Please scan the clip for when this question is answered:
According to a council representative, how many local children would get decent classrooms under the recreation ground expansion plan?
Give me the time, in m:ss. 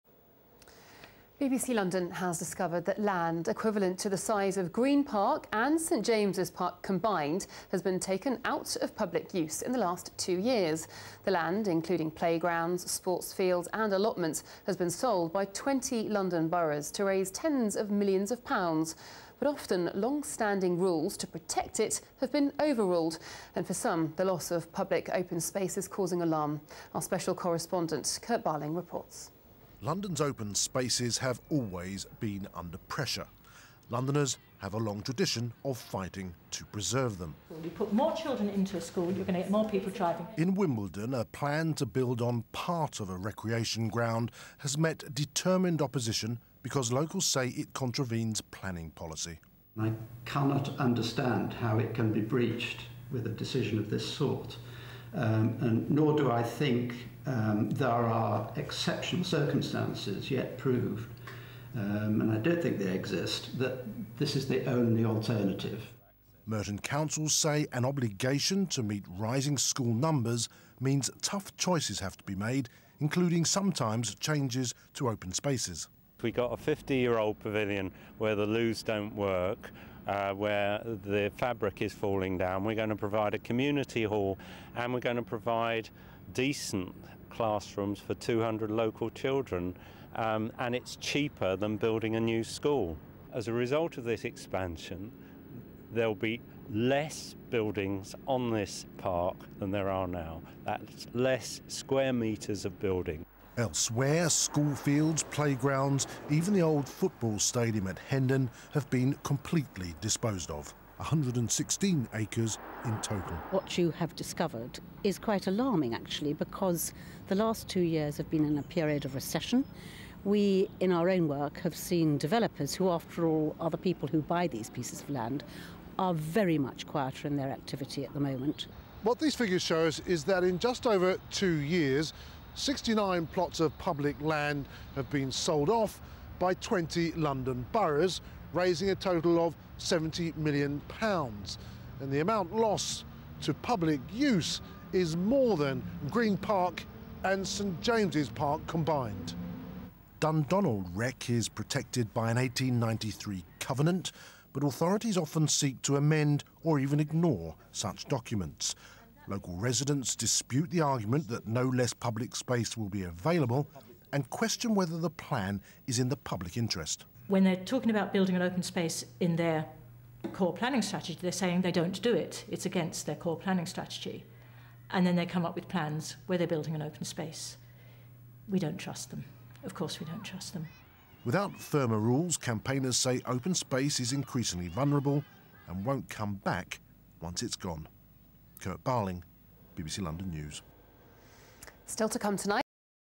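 1:28.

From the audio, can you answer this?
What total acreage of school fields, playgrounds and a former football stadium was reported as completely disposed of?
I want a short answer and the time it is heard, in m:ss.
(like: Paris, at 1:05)
116 acres, at 1:50.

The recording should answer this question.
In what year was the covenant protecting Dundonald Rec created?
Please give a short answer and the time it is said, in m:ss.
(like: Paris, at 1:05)
1893, at 2:32.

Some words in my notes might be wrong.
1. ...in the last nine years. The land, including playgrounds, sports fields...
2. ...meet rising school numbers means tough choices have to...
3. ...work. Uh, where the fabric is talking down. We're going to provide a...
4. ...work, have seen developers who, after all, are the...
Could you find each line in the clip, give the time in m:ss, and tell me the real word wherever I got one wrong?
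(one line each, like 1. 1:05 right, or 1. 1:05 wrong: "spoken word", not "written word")
1. 0:09 wrong: "two", not "nine"
2. 1:08 right
3. 1:19 wrong: "falling", not "talking"
4. 2:01 right.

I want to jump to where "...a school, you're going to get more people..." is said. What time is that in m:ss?
0:38.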